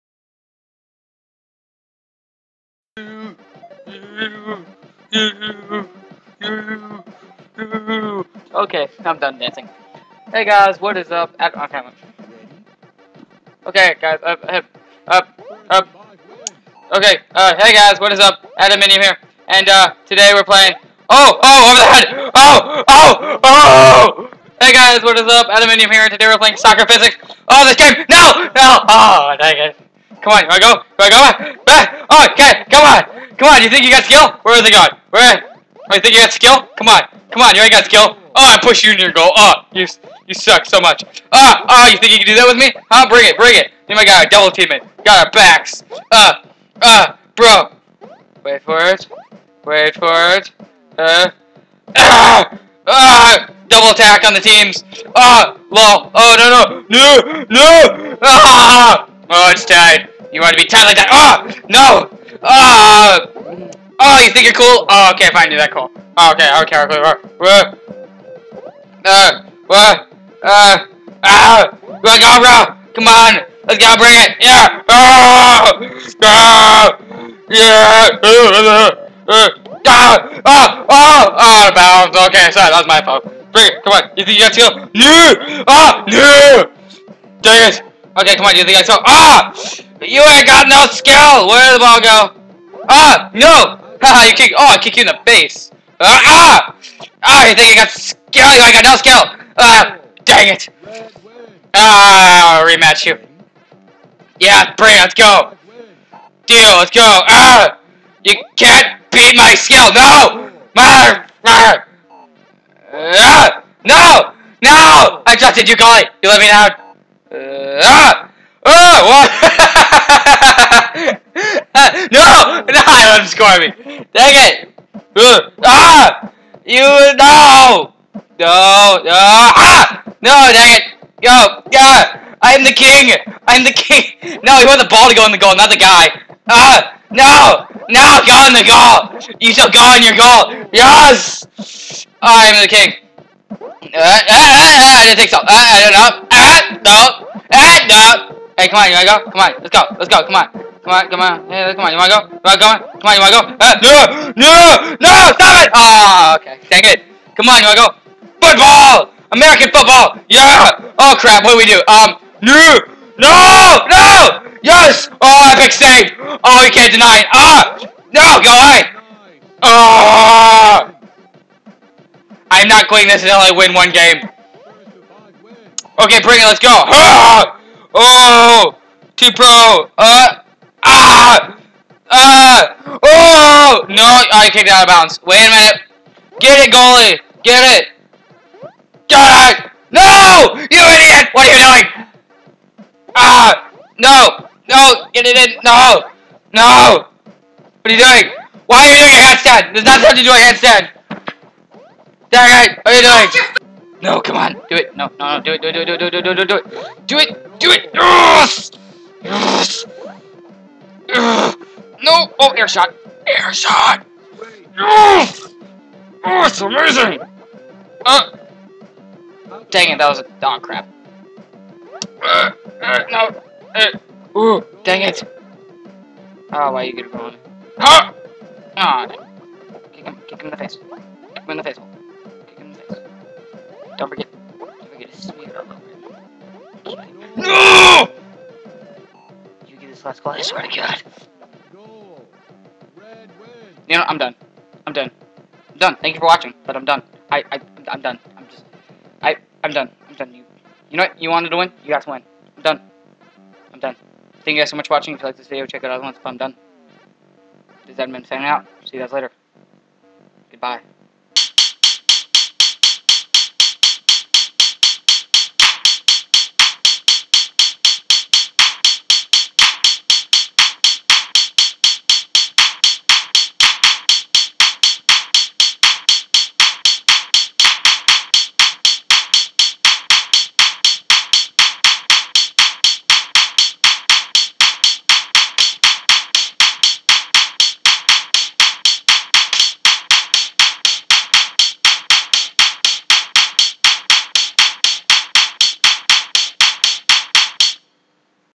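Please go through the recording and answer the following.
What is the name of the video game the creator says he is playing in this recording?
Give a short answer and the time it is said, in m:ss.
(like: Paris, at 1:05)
Soccer Physics, at 0:26.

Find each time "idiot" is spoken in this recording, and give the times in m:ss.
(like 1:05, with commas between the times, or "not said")
3:10.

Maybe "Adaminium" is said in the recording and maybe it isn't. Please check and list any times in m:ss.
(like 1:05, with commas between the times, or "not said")
0:18, 0:25.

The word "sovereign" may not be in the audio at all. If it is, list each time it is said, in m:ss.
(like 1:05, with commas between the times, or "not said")
not said.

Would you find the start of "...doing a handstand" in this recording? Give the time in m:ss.
3:18.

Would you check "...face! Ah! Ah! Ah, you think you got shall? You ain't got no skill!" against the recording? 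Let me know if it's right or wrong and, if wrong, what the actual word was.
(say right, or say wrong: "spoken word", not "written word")
wrong: "skill", not "shall".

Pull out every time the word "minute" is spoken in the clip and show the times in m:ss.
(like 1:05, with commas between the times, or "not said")
3:05.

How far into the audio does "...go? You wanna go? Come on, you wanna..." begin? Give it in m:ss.
2:32.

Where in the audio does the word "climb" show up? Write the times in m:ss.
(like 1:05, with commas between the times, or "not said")
not said.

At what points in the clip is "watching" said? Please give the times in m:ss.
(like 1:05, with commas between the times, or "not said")
4:06, 4:14.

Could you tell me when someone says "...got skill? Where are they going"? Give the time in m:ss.
0:33.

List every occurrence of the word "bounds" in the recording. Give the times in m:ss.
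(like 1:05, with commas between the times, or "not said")
1:21, 3:04.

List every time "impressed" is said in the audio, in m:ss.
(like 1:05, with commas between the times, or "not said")
not said.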